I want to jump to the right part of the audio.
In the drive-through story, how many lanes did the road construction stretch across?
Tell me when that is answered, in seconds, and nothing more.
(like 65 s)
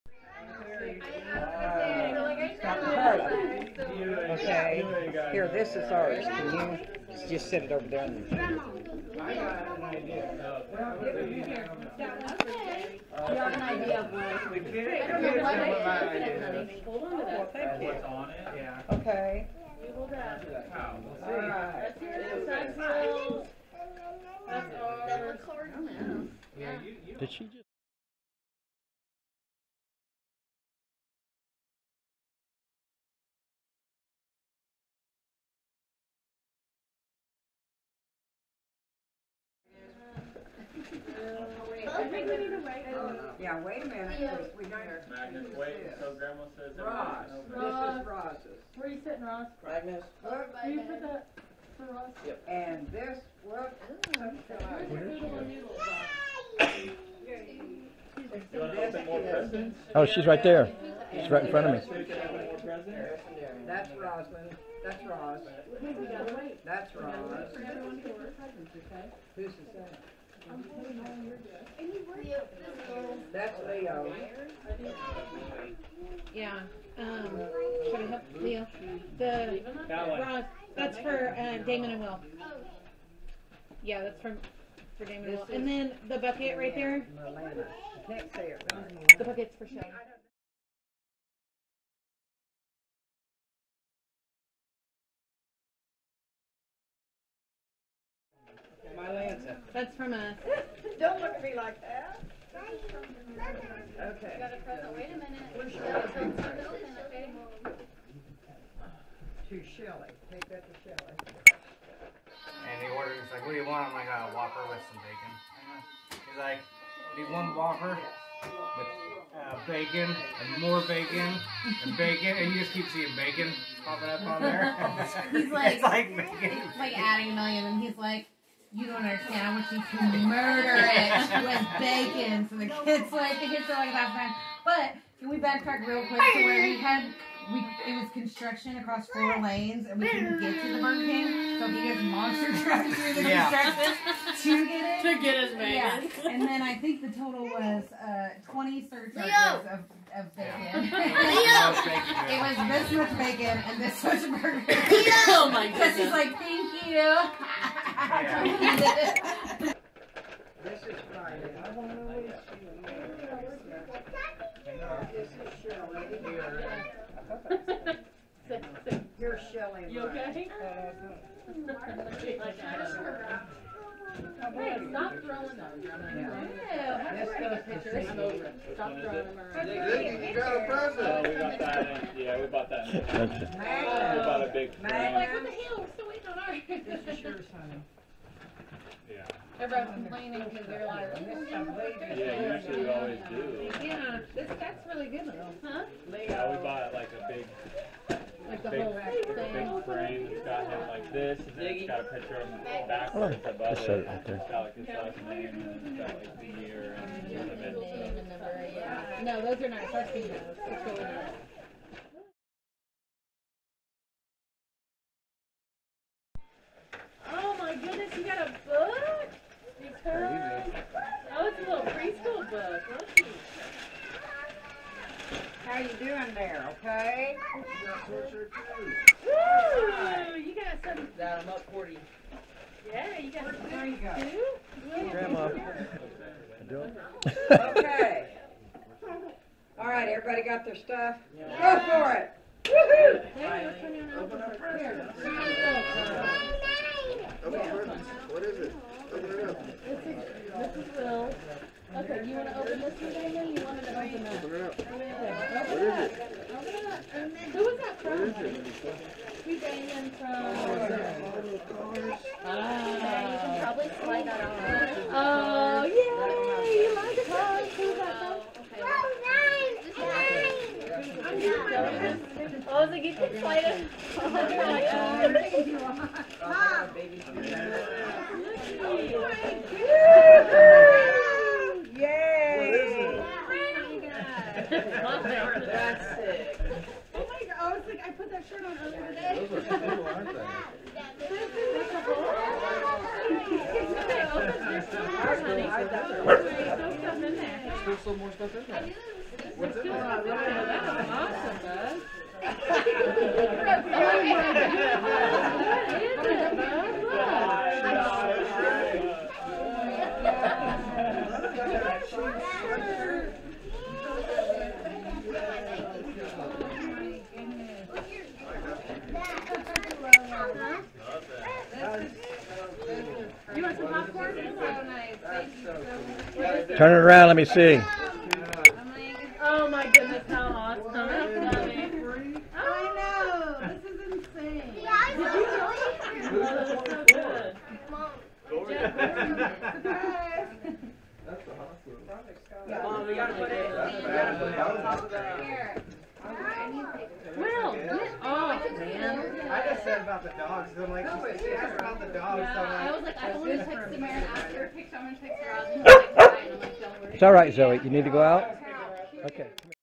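139 s.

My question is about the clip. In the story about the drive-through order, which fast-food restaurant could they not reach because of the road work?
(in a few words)
Burger King.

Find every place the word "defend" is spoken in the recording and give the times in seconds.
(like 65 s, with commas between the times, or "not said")
not said.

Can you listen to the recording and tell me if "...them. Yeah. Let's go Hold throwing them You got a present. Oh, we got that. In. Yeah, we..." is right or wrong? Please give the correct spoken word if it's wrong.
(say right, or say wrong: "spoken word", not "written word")
wrong: "Stop", not "Hold".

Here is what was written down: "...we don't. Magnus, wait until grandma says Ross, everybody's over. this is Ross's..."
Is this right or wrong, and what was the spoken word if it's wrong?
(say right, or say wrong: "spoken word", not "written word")
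right.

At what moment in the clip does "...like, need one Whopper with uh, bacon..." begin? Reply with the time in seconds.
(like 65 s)
116 s.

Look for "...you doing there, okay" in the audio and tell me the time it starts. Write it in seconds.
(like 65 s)
225 s.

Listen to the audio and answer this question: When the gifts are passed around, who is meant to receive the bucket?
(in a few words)
Shelly.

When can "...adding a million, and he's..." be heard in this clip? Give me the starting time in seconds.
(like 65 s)
126 s.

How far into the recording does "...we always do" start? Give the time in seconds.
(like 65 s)
192 s.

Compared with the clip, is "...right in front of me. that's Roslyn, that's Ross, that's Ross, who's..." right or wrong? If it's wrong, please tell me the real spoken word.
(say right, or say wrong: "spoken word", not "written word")
right.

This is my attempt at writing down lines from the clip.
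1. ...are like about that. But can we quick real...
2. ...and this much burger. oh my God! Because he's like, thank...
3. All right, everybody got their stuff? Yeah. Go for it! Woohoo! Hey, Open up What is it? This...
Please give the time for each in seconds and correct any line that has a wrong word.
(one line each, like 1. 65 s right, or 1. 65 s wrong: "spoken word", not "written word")
1. 133 s wrong: "backtrack", not "quick"
2. 153 s right
3. 239 s right.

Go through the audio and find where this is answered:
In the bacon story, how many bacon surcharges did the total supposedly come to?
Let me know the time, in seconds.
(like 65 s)
148 s.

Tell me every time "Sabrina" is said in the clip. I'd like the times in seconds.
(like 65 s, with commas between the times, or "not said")
not said.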